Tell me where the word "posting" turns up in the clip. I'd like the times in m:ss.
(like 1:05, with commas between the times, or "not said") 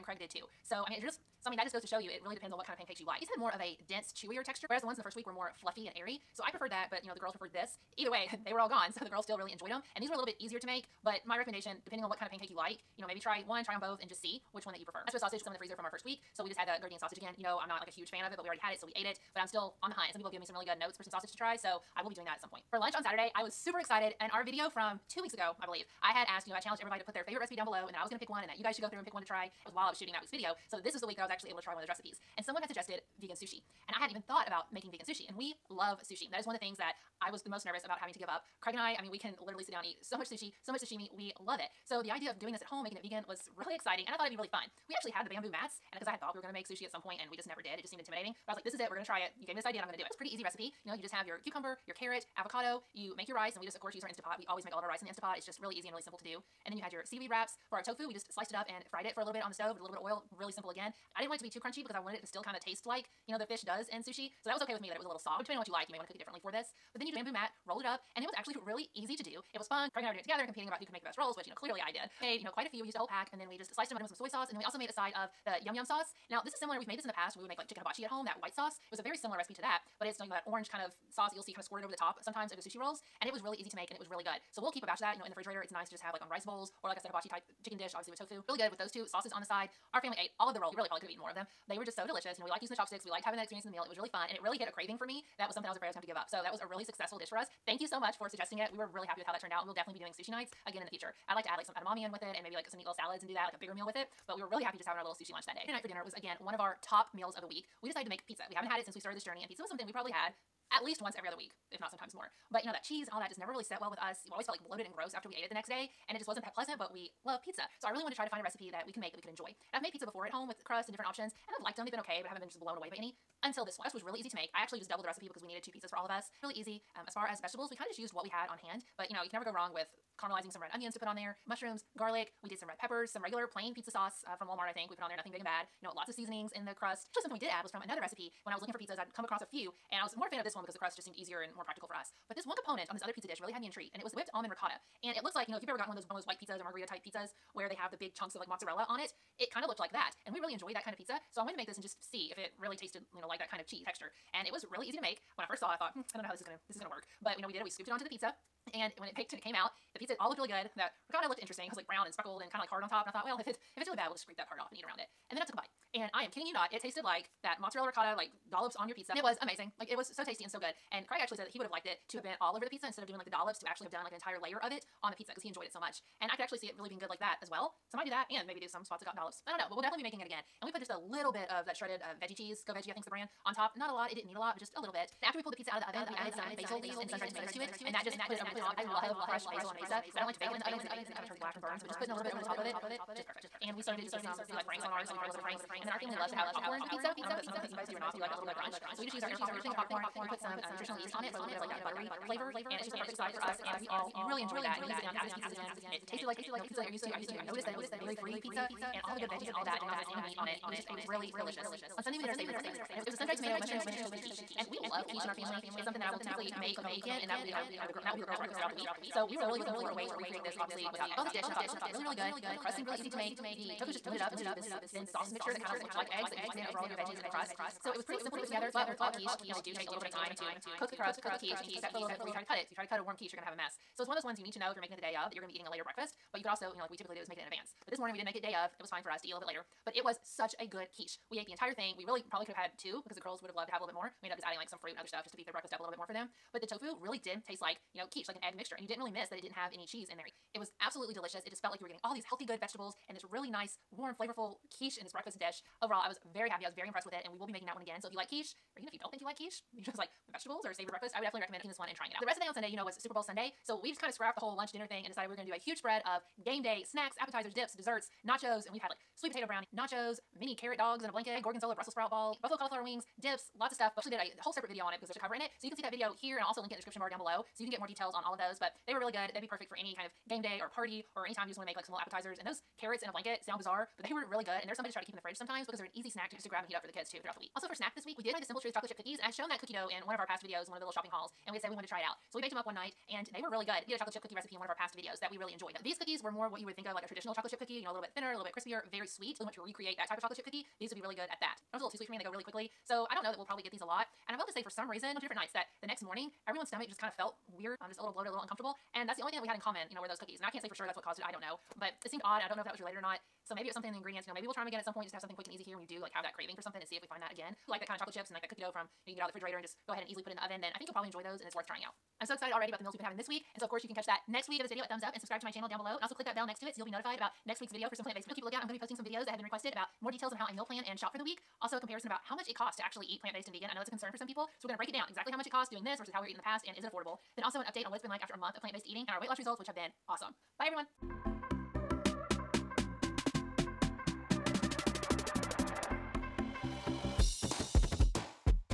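5:28.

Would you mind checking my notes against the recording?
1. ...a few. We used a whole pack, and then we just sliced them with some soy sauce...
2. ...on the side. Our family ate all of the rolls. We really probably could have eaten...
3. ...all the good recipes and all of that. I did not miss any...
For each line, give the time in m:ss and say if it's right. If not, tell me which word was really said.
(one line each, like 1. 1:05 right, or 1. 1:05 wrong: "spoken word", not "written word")
1. 1:12 right
2. 1:29 right
3. 3:29 wrong: "veggies", not "recipes".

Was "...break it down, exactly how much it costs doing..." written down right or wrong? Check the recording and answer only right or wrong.
right.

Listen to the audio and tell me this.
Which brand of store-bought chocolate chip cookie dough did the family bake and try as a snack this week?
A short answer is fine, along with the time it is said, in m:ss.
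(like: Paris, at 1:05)
Simple Truth, at 4:48.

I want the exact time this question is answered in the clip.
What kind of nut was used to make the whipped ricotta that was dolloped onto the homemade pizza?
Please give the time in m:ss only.
2:24.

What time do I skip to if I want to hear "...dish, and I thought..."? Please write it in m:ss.
3:41.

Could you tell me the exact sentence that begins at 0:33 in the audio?
And I hadn't even thought about making vegan sushi.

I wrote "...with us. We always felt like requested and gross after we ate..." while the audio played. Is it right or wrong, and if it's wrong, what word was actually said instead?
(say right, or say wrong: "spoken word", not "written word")
wrong: "bloated", not "requested".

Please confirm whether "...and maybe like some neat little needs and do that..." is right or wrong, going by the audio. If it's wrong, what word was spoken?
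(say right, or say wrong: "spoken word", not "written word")
wrong: "salads", not "needs".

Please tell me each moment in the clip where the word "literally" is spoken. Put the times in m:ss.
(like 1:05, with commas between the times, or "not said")
0:39.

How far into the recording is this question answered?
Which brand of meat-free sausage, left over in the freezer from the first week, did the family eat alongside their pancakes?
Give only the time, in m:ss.
0:16.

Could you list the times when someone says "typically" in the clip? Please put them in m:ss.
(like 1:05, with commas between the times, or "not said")
3:36, 3:56.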